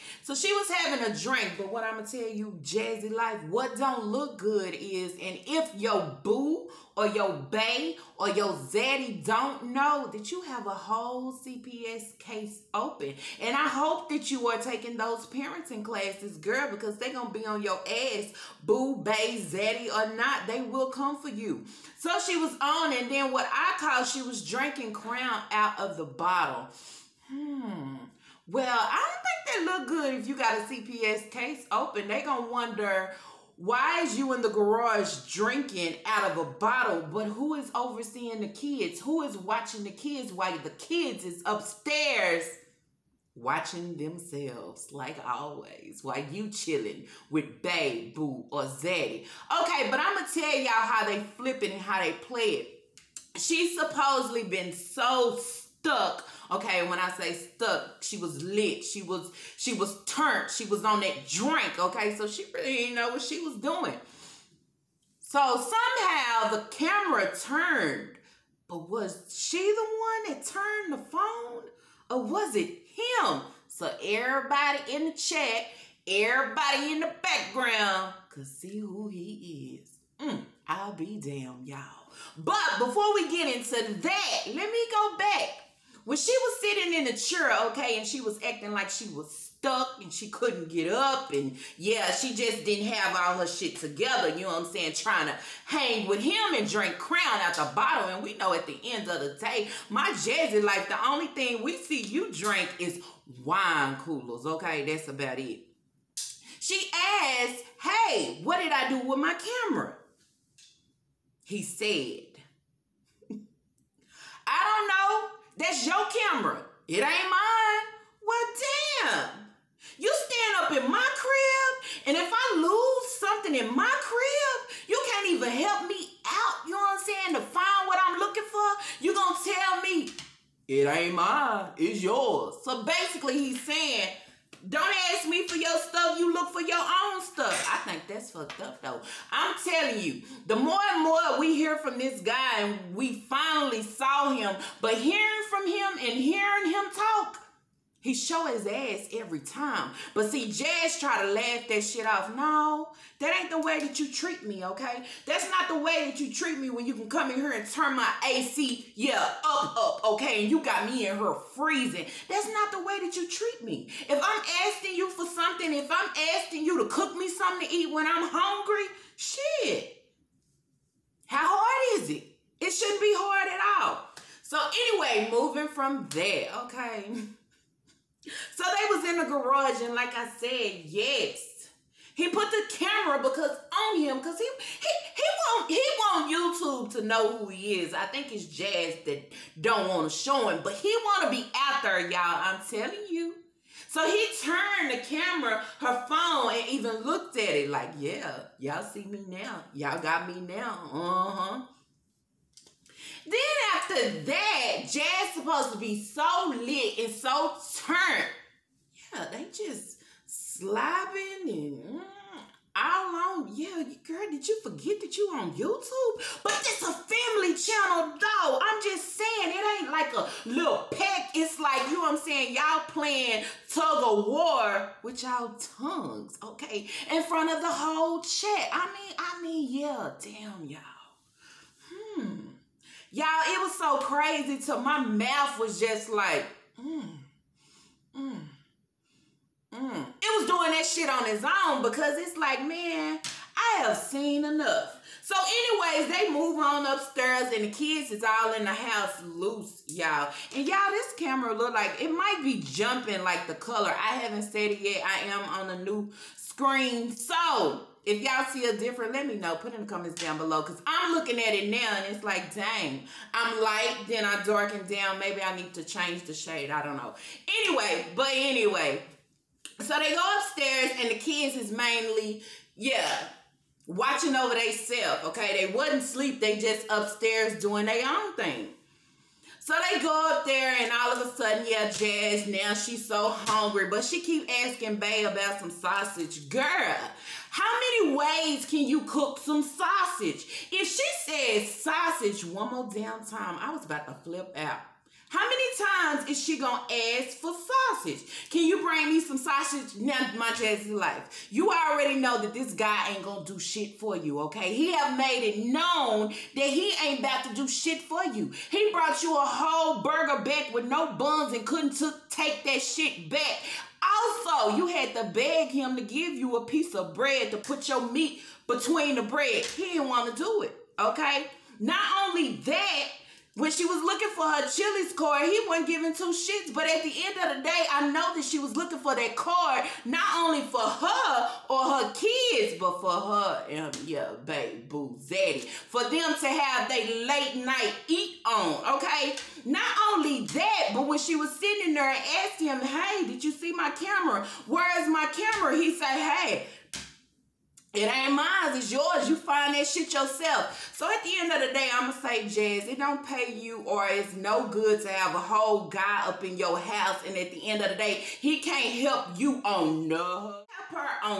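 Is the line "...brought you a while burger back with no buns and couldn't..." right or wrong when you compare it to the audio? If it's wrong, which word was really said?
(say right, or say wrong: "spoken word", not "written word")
wrong: "whole", not "while".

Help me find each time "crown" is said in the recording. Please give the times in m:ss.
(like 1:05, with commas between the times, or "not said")
0:24, 1:36.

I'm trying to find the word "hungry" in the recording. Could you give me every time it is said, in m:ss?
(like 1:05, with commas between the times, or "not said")
2:48, 4:43.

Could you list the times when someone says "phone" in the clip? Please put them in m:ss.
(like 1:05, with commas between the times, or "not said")
1:11, 3:16.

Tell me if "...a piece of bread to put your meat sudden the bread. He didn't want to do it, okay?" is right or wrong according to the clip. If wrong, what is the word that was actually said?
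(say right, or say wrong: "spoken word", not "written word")
wrong: "between", not "sudden".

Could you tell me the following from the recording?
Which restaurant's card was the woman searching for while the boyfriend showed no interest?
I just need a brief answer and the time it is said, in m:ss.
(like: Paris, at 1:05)
Chili's, at 5:24.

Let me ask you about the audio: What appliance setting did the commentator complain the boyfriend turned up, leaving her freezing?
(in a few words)
AC.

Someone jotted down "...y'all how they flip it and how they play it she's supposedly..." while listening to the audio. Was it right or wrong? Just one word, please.
right.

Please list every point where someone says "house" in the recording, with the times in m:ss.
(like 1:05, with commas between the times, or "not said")
4:08, 5:56.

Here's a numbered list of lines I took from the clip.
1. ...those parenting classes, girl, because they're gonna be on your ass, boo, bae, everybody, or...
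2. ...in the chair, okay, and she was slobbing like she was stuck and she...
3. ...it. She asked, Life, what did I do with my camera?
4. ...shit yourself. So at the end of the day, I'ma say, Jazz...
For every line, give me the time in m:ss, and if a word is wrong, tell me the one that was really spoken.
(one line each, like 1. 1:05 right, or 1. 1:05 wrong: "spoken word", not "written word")
1. 0:14 wrong: "zaddy", not "everybody"
2. 1:26 wrong: "acting", not "slobbing"
3. 1:45 wrong: "Hey", not "Life"
4. 5:49 right.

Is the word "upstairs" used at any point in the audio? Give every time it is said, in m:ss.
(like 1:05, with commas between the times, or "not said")
0:41, 4:06, 4:30, 4:36.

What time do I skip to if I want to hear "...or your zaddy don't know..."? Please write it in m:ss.
0:08.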